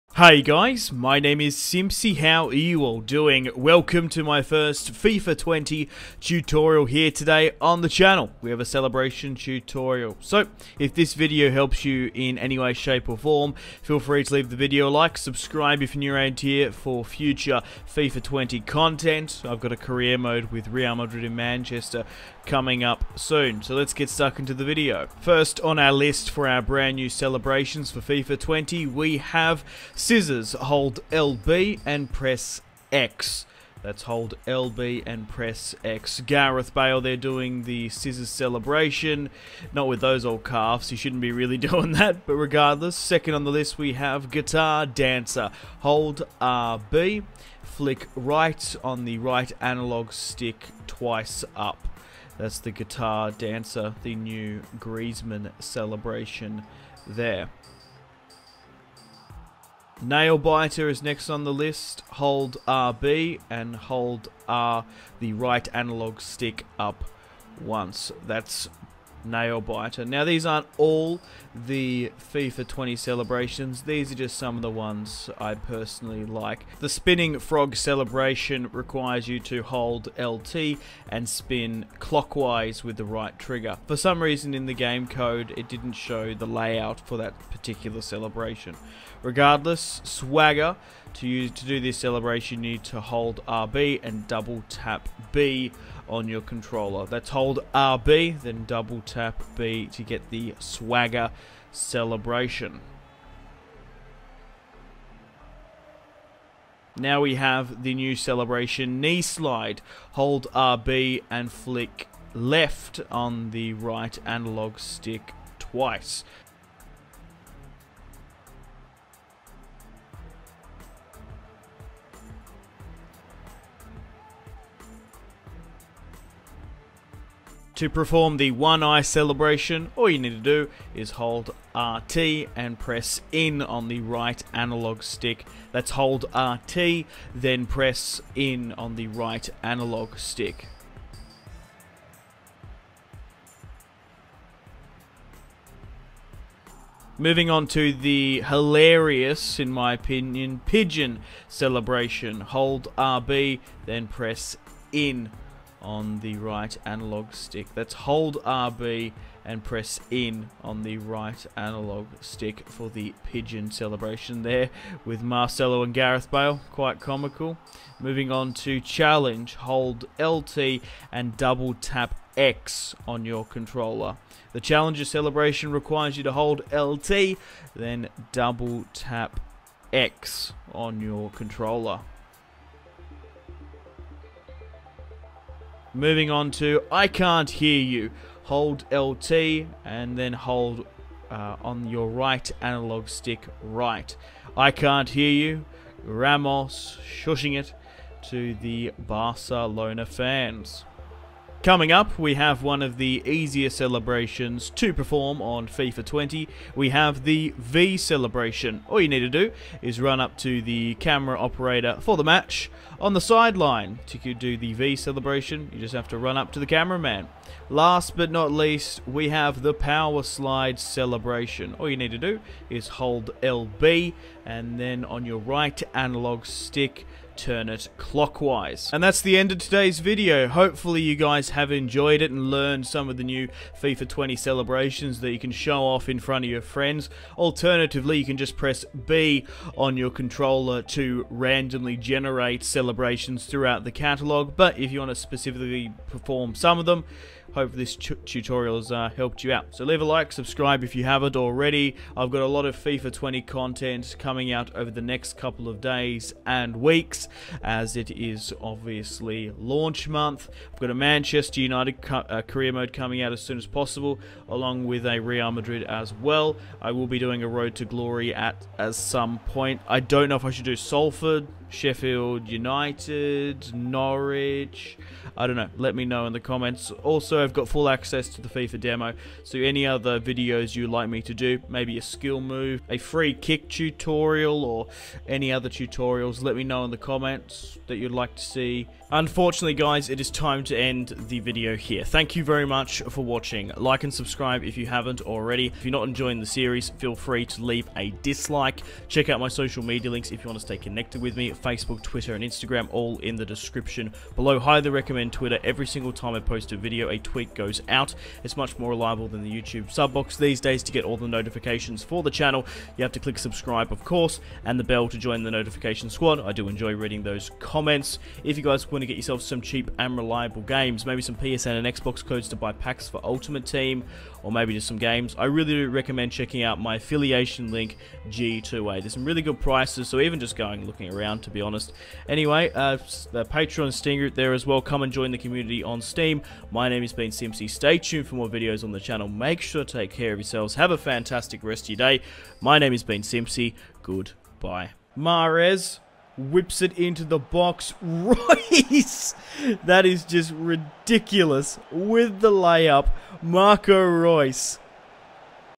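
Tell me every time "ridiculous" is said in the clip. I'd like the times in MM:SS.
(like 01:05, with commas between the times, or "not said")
05:50.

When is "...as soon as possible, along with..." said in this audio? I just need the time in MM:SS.
04:23.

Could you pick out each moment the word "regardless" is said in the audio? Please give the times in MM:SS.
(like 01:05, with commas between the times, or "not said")
00:42, 01:29.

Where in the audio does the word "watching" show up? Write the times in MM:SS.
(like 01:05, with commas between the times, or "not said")
04:53.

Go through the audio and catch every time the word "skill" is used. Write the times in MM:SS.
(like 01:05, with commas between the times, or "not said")
04:42.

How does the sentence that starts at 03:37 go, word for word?
Last but not least, we have the power slide celebration.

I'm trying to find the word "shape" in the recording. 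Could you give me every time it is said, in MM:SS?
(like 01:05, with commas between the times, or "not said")
00:12.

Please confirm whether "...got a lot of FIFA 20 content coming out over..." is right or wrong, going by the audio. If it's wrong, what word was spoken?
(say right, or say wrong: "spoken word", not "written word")
right.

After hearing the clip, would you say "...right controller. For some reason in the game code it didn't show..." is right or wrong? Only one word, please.
wrong.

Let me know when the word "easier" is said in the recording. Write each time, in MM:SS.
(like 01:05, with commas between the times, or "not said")
03:23.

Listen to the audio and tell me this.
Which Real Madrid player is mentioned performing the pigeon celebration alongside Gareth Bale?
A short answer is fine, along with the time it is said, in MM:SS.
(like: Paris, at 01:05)
Marcelo, at 02:45.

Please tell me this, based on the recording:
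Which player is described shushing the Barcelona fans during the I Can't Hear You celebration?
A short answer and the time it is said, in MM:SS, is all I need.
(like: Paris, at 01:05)
Ramos, at 03:16.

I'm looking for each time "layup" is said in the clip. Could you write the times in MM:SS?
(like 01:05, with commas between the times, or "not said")
05:52.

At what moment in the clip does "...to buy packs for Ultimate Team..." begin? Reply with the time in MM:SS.
05:22.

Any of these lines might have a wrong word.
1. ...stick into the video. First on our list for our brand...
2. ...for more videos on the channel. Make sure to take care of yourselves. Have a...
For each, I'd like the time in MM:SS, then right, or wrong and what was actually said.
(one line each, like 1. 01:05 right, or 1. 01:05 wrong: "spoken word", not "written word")
1. 00:24 wrong: "stuck", not "stick"
2. 05:38 right.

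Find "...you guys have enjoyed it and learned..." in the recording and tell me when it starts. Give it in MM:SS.
03:51.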